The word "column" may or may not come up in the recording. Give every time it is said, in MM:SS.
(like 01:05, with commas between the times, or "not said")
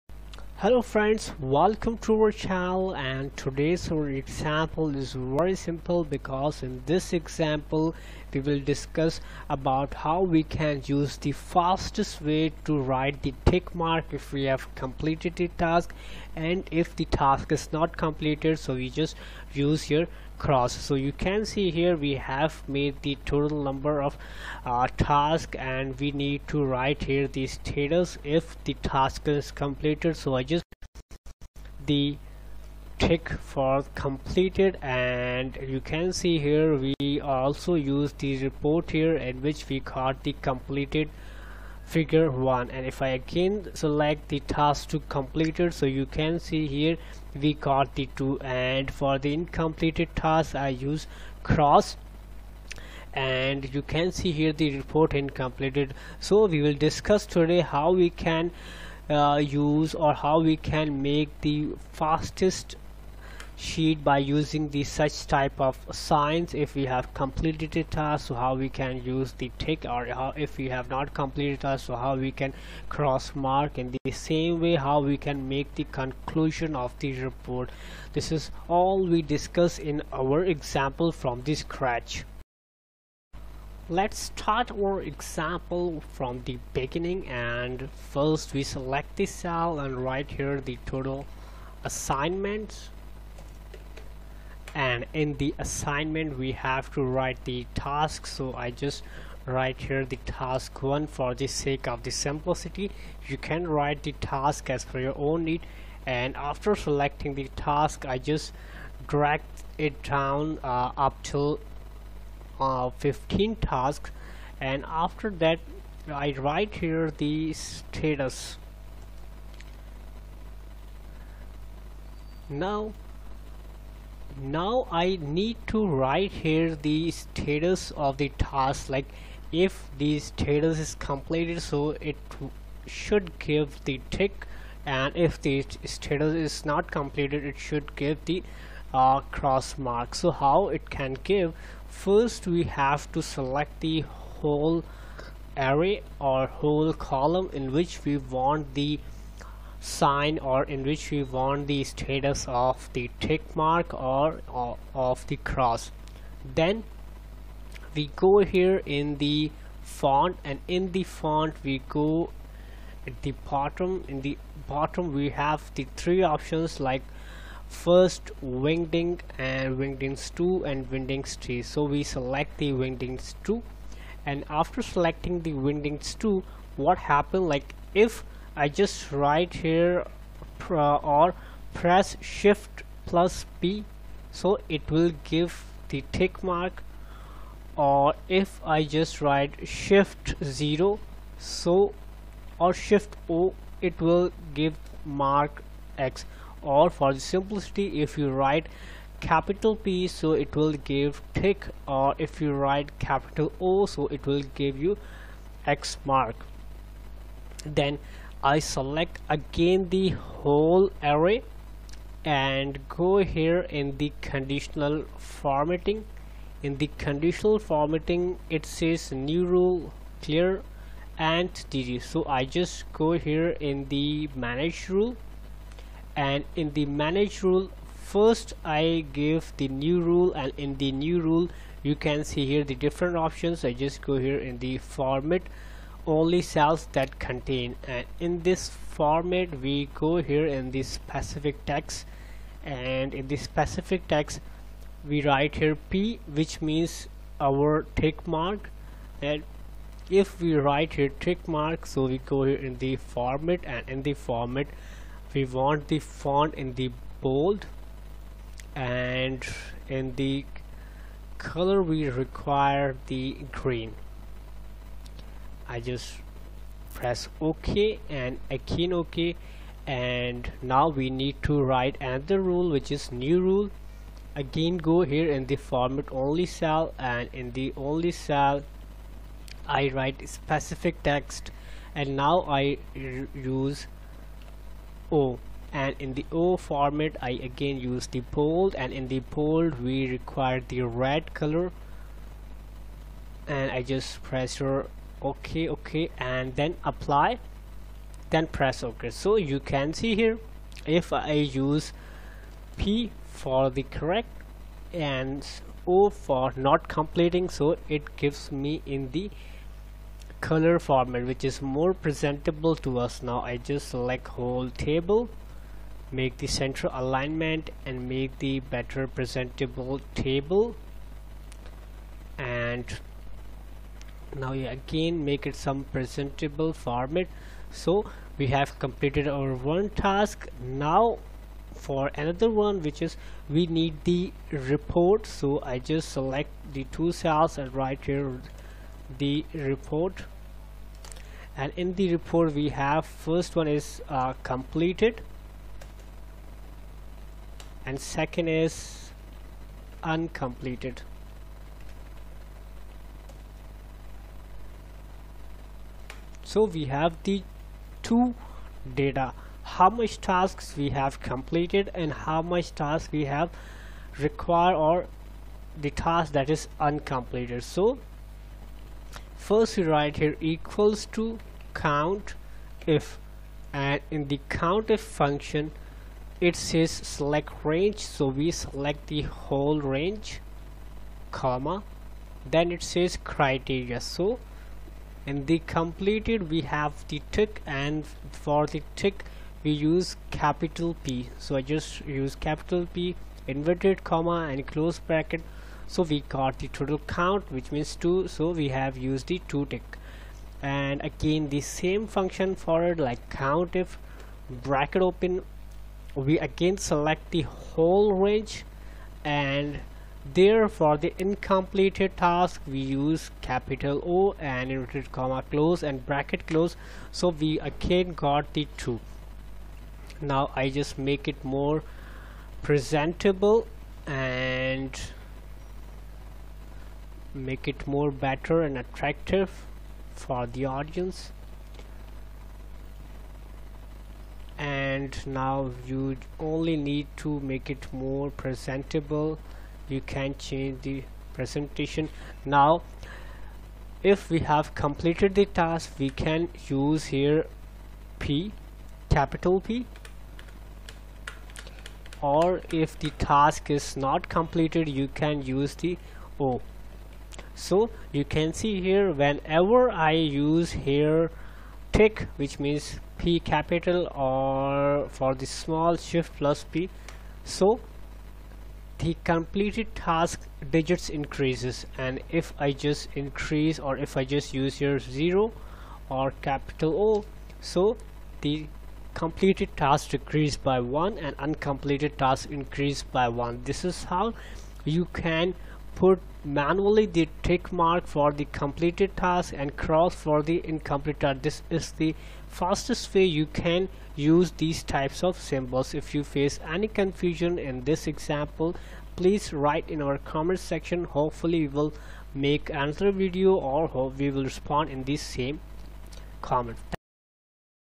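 02:26.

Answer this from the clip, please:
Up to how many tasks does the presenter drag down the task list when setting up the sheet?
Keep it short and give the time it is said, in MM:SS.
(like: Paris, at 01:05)
15, at 01:52.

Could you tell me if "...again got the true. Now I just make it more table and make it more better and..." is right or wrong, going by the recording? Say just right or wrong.
wrong.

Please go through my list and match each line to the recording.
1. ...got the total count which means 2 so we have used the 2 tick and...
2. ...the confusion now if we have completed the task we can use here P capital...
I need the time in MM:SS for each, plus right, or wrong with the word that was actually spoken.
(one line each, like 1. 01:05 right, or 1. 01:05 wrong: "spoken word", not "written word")
1. 06:36 right
2. 07:20 wrong: "presentation", not "confusion".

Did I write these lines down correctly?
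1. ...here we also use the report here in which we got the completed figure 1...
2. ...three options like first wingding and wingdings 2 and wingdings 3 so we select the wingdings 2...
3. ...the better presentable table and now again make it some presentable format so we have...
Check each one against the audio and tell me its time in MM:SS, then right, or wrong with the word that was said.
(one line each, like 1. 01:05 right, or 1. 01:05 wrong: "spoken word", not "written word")
1. 00:36 right
2. 02:45 right
3. 05:18 right.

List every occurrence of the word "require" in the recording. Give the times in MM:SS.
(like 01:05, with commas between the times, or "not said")
04:22, 04:50, 06:04.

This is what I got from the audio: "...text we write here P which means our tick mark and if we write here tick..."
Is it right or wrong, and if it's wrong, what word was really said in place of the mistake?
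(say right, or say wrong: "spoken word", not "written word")
right.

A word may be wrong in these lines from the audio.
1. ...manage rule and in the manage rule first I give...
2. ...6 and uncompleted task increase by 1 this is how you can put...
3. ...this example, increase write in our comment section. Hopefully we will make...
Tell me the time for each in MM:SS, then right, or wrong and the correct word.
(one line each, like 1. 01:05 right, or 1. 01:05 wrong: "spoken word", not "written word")
1. 03:44 right
2. 08:00 wrong: "1", not "6"
3. 08:17 wrong: "please", not "increase".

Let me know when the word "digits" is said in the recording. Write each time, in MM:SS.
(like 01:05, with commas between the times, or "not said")
07:50.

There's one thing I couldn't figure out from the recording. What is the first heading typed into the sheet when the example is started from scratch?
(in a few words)
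Total assignments.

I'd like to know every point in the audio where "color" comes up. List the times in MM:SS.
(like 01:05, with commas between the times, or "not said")
04:21, 04:51, 05:10.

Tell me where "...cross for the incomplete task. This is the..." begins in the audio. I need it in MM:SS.
08:09.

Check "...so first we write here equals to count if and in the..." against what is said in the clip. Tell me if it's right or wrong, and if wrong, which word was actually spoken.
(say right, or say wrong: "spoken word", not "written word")
right.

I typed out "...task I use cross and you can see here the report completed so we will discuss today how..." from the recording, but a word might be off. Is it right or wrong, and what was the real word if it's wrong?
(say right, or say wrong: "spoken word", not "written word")
wrong: "incompleted", not "completed".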